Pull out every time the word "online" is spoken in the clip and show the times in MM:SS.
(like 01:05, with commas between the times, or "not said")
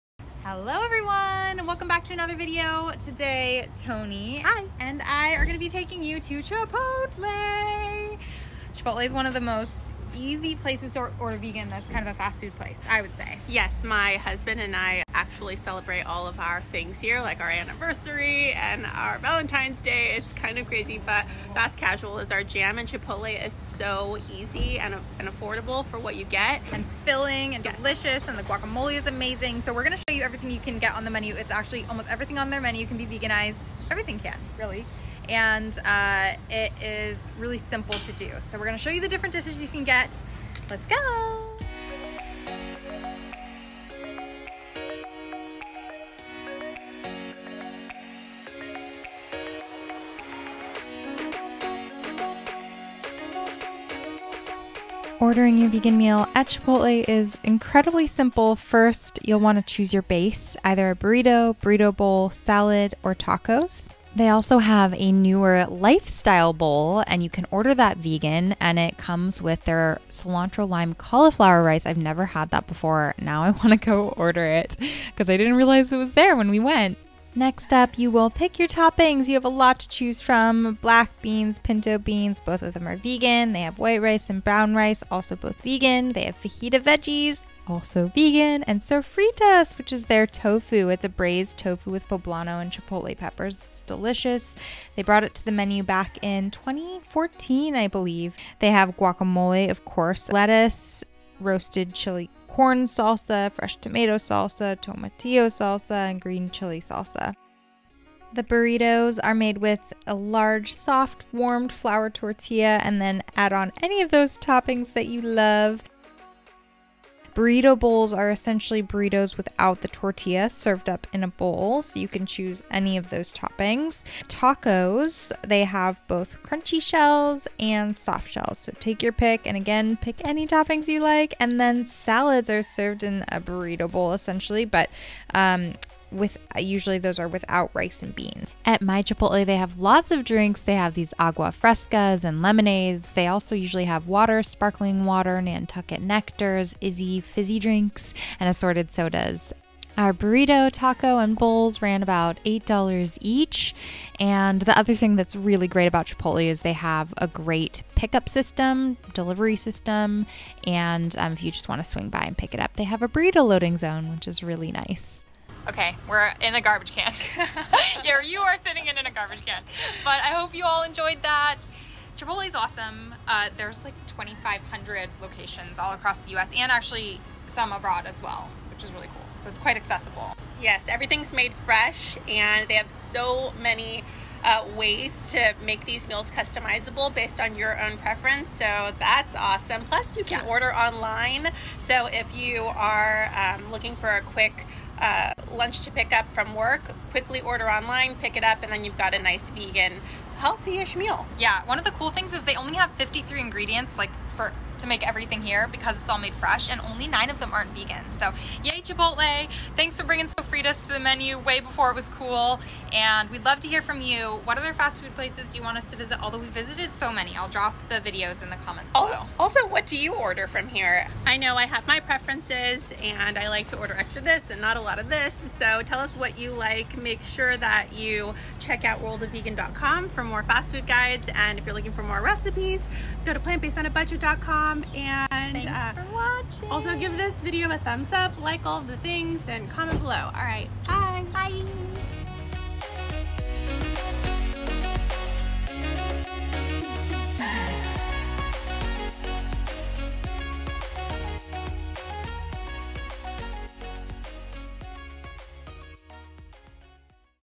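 03:10, 03:17.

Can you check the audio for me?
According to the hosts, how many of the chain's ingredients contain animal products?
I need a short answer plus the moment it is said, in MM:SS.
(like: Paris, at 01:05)
9, at 03:27.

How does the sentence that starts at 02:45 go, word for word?
Okay, we're in a garbage can.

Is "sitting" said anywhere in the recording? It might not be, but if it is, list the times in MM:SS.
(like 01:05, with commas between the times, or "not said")
02:48.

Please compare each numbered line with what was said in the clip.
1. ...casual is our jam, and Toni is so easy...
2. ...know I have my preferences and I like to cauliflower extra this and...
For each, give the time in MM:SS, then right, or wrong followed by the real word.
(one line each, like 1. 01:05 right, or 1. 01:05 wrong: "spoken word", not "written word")
1. 00:21 wrong: "Chipotle", not "Toni"
2. 03:41 wrong: "order", not "cauliflower".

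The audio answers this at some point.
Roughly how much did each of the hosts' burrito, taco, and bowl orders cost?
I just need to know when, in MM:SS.
02:32.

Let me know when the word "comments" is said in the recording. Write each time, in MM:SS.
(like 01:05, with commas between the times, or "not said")
03:38, 03:59.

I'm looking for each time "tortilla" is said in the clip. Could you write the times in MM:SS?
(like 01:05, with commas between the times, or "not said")
01:52, 01:59.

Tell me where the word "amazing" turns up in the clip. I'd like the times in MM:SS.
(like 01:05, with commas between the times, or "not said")
00:29.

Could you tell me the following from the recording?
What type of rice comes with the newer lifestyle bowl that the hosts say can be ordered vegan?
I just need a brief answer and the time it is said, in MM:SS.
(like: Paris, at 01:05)
Cilantro lime cauliflower rice, at 01:10.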